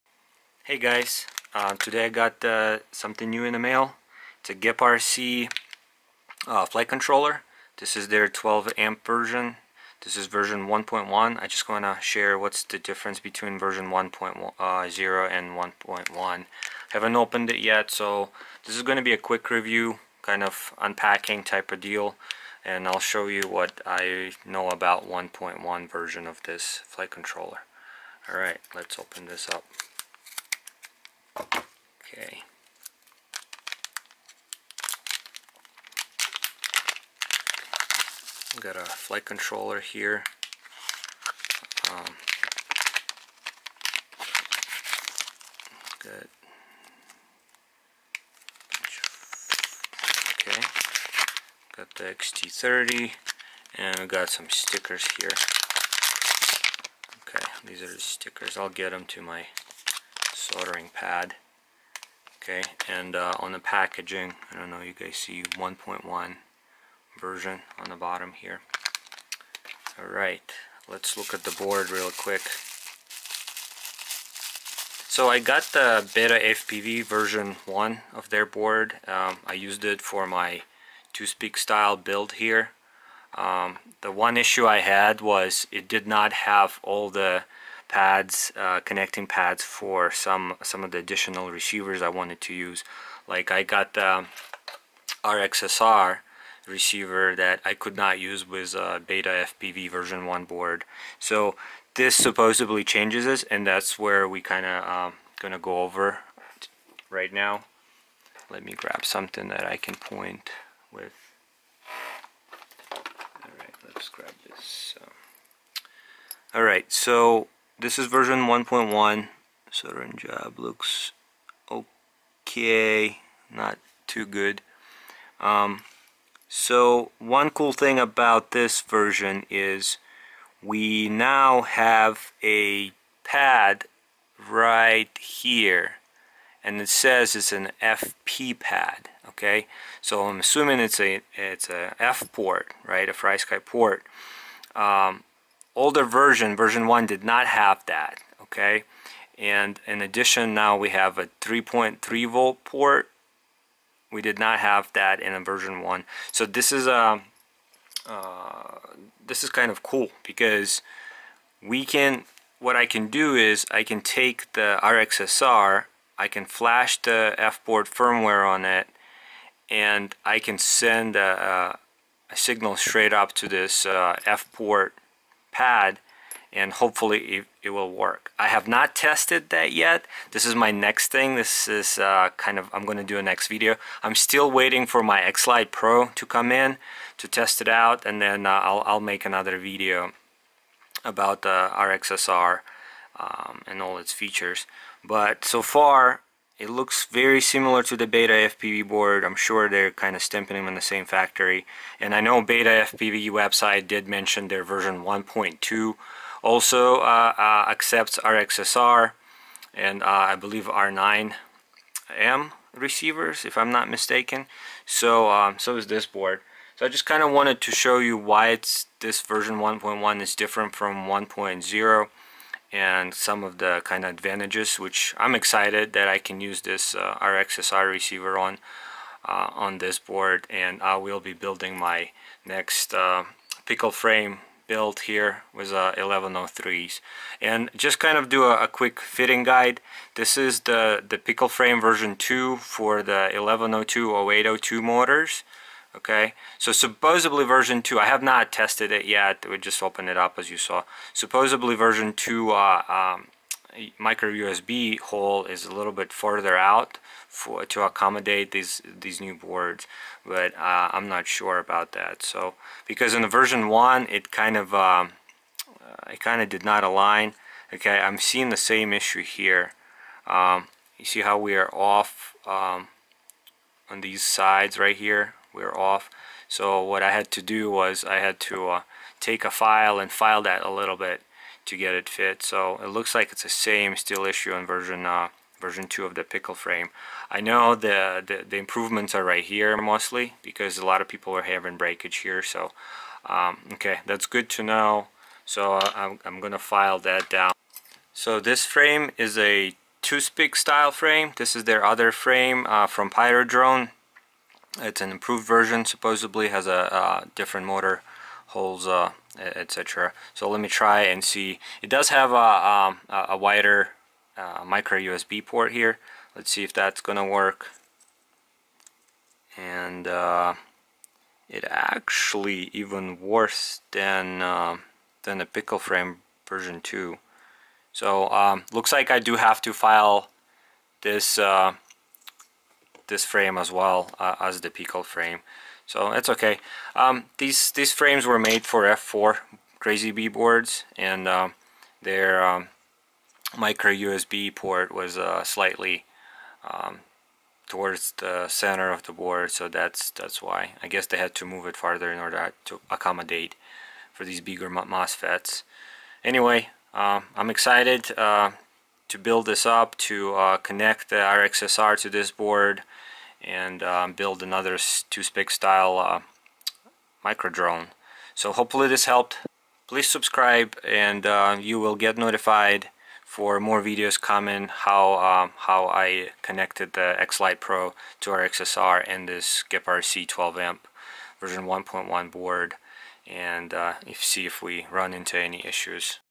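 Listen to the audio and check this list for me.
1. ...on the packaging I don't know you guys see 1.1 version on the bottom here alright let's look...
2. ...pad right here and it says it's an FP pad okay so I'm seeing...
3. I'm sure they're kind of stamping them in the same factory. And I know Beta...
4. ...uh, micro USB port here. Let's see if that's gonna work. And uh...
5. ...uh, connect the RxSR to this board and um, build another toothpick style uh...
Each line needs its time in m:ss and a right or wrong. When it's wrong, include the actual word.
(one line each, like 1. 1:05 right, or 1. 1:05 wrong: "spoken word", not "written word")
1. 1:03 right
2. 2:13 wrong: "assuming", not "seeing"
3. 3:19 right
4. 5:14 right
5. 6:00 right.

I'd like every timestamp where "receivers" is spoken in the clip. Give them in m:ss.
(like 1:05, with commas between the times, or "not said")
1:31, 1:36, 3:32, 3:47.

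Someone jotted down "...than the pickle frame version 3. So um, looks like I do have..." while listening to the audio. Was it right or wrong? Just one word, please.
wrong.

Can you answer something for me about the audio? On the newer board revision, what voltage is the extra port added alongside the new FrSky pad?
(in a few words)
3.3 volt.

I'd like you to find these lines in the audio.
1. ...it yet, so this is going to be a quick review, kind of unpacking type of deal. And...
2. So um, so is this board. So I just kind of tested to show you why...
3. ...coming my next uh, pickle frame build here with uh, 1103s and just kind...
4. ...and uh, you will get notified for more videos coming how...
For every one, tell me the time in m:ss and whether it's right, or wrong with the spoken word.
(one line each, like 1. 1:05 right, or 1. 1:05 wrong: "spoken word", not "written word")
1. 0:17 right
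2. 3:34 wrong: "wanted", not "tested"
3. 3:51 wrong: "building", not "coming"
4. 6:10 right.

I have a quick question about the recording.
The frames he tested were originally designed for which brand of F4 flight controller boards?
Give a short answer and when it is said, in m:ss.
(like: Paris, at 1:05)
CrazyBee, at 5:39.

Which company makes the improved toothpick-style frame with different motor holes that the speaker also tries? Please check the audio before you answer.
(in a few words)
Pyrodrone.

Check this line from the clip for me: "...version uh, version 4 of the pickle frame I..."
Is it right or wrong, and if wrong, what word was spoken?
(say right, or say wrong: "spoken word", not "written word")
wrong: "2", not "4".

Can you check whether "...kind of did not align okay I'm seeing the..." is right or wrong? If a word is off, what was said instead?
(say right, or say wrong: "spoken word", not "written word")
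right.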